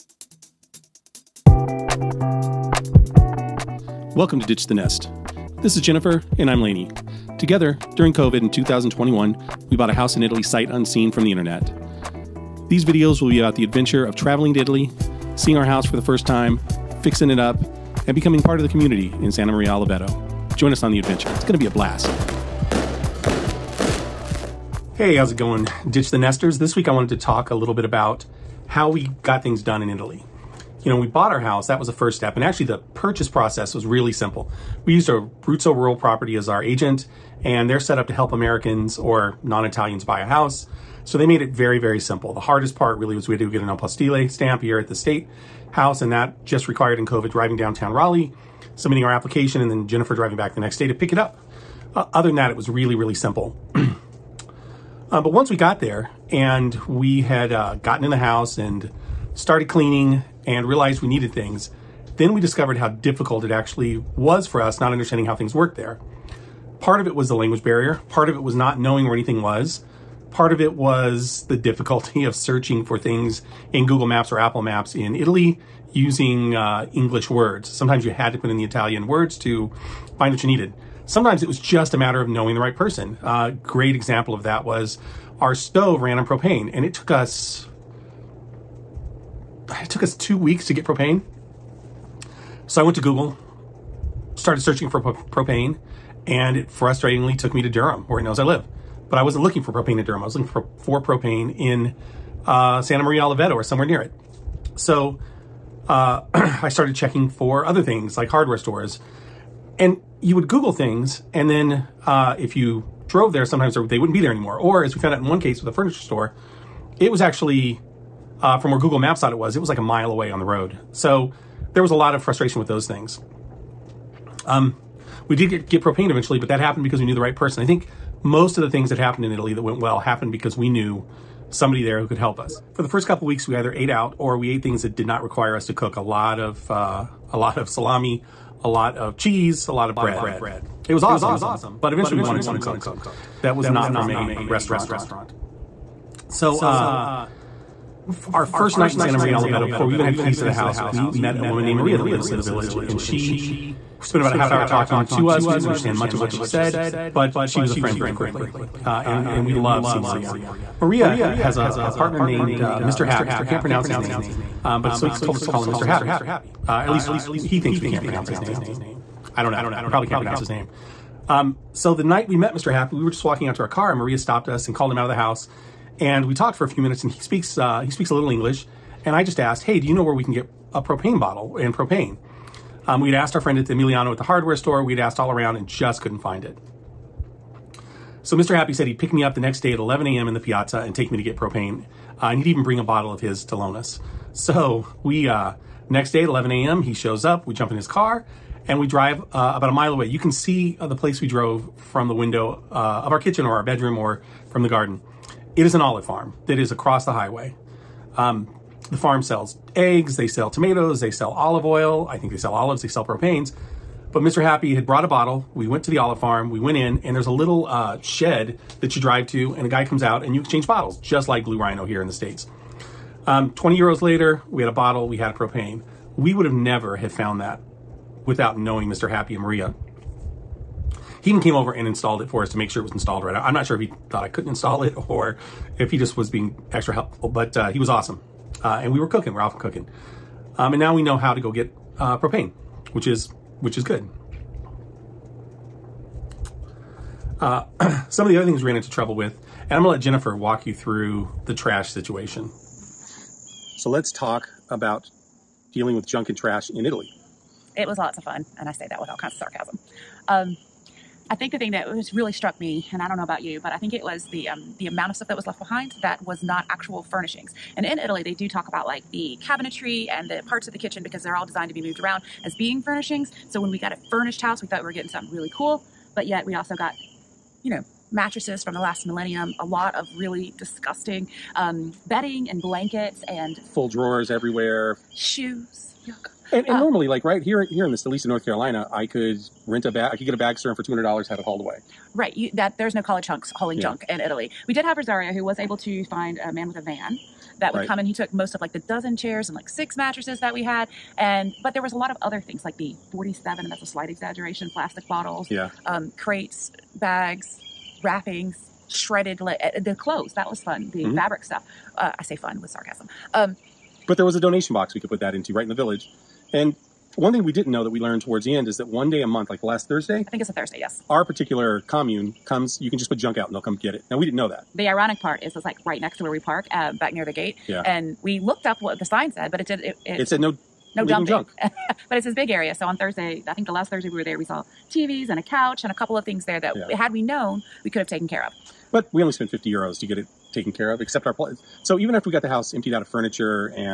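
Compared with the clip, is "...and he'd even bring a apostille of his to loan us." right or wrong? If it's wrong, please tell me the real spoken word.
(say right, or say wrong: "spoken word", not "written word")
wrong: "bottle", not "apostille".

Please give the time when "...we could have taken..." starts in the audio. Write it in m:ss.
5:37.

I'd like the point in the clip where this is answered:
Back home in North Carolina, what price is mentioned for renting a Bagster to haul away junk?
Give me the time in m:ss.
4:50.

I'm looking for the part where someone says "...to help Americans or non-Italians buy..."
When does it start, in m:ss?
0:38.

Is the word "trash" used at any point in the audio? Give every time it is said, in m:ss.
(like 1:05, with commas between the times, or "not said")
4:11, 4:16.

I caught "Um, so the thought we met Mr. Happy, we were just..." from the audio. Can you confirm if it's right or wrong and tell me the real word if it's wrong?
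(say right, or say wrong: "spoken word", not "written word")
wrong: "night", not "thought".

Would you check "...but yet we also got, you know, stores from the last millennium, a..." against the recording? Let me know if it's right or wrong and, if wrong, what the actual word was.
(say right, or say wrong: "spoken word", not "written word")
wrong: "mattresses", not "stores".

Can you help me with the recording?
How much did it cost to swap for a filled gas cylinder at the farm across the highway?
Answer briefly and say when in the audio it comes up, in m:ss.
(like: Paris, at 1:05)
20 euros, at 3:43.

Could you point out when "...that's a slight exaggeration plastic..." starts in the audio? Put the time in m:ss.
5:03.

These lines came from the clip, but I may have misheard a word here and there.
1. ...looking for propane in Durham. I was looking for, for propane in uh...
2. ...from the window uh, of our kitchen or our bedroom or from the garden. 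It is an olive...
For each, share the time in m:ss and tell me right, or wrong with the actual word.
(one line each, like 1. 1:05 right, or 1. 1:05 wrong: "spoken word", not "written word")
1. 1:39 right
2. 3:21 right.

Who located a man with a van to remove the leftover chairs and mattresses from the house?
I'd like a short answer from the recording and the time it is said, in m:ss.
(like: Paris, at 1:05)
Rosario, at 4:54.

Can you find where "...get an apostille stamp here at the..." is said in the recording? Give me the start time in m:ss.
0:43.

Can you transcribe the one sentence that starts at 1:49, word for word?
And you would Google things, and then uh, if you drove there, sometimes they wouldn't be there anymore.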